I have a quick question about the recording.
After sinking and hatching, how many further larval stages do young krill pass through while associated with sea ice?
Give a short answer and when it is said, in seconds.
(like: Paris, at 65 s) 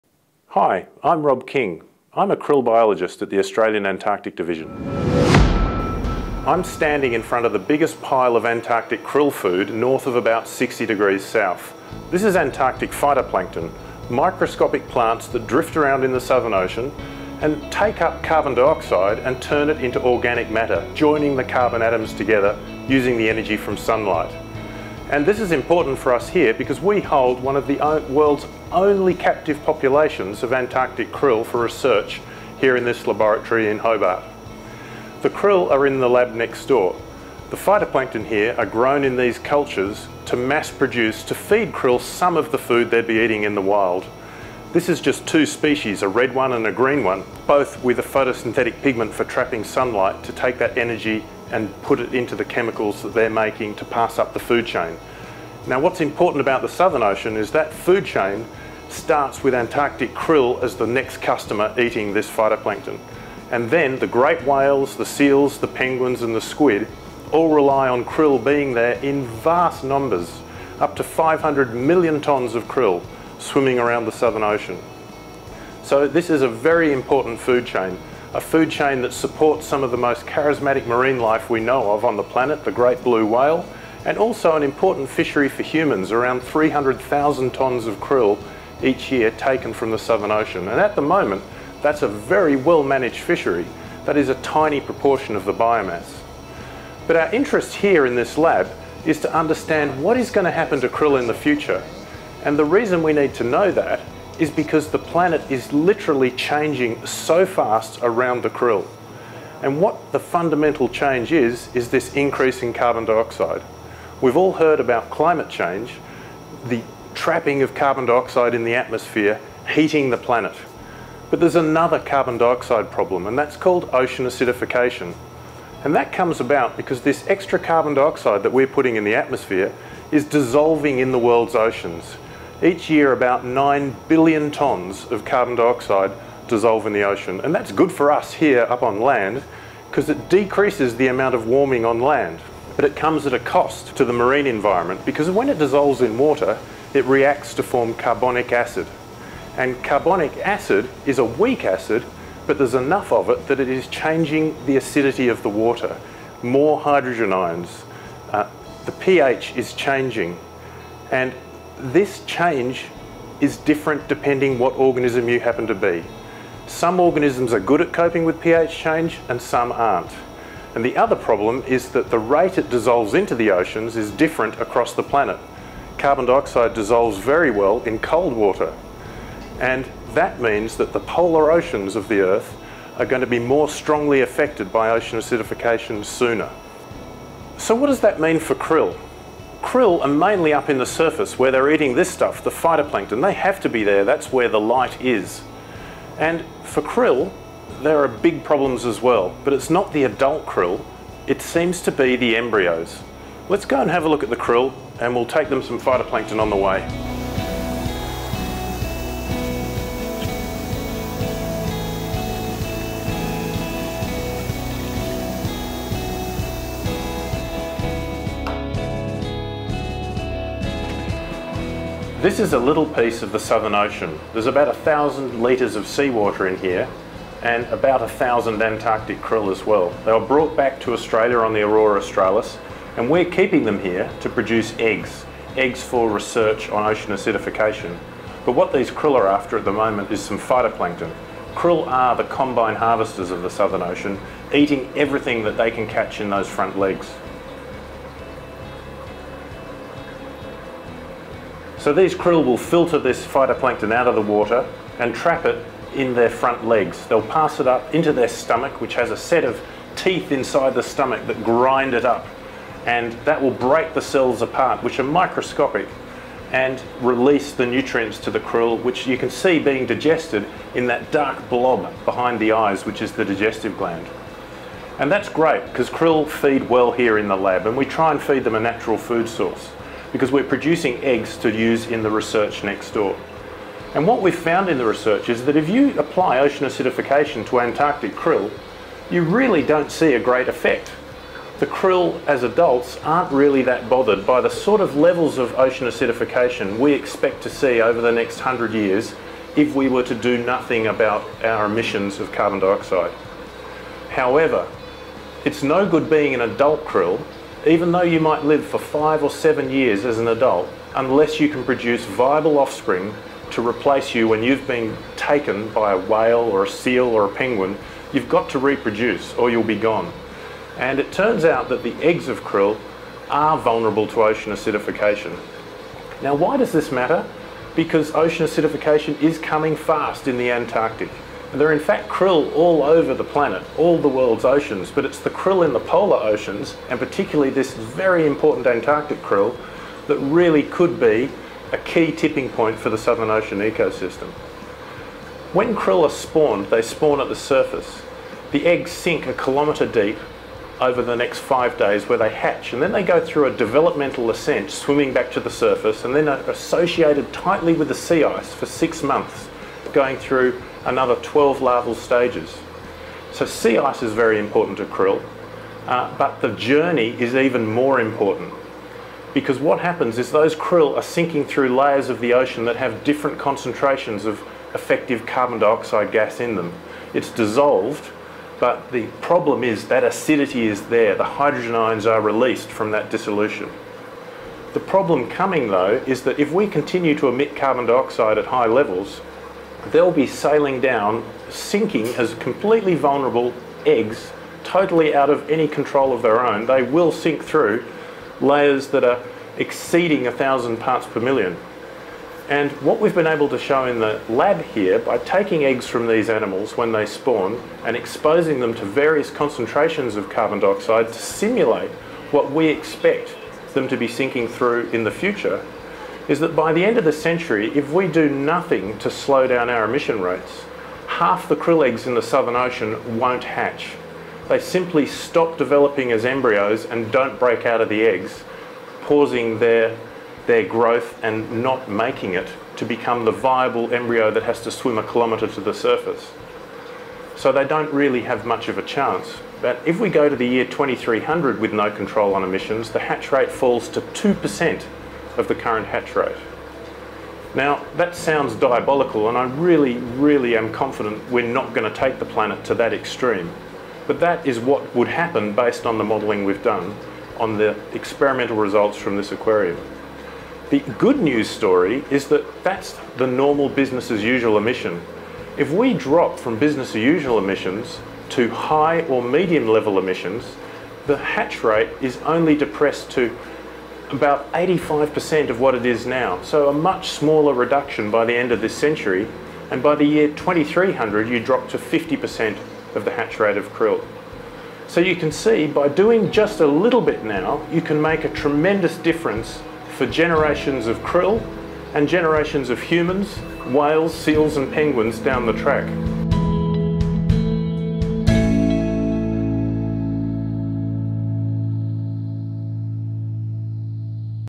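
12, at 361 s.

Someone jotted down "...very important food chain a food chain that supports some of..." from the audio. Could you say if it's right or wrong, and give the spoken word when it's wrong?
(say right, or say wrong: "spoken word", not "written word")
right.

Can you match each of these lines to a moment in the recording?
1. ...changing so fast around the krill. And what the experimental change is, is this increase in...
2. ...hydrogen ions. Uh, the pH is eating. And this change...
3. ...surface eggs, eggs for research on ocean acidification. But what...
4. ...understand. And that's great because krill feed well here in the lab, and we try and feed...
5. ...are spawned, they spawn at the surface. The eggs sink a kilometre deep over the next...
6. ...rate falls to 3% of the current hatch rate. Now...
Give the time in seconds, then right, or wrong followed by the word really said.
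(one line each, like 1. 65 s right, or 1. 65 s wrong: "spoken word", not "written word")
1. 106 s wrong: "fundamental", not "experimental"
2. 156 s wrong: "changing", not "eating"
3. 234 s wrong: "produce", not "surface"
4. 273 s wrong: "gland", not "understand"
5. 346 s right
6. 443 s wrong: "2", not "3".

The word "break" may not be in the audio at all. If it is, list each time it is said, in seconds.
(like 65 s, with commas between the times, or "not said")
263 s, 427 s.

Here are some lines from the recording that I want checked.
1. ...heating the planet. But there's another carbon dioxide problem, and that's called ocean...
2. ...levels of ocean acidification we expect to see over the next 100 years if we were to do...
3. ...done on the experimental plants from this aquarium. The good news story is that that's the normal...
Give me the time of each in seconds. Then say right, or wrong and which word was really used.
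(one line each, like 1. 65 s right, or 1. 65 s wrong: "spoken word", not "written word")
1. 119 s right
2. 294 s right
3. 456 s wrong: "results", not "plants".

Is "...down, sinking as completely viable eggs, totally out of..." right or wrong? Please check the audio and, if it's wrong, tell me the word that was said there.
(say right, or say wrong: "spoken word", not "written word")
wrong: "vulnerable", not "viable".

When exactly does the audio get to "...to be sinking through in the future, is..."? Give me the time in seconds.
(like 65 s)
413 s.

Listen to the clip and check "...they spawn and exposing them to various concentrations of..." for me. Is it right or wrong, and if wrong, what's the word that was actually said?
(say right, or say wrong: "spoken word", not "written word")
right.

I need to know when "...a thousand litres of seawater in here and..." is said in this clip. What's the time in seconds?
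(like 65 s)
224 s.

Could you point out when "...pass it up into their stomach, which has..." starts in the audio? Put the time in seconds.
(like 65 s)
257 s.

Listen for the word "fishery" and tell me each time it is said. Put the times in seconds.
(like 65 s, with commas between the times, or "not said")
85 s, 93 s.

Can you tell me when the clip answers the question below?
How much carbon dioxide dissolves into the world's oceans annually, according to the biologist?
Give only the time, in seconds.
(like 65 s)
133 s.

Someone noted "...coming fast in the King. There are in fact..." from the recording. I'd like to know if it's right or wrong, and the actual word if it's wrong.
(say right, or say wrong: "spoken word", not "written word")
wrong: "Antarctic", not "King".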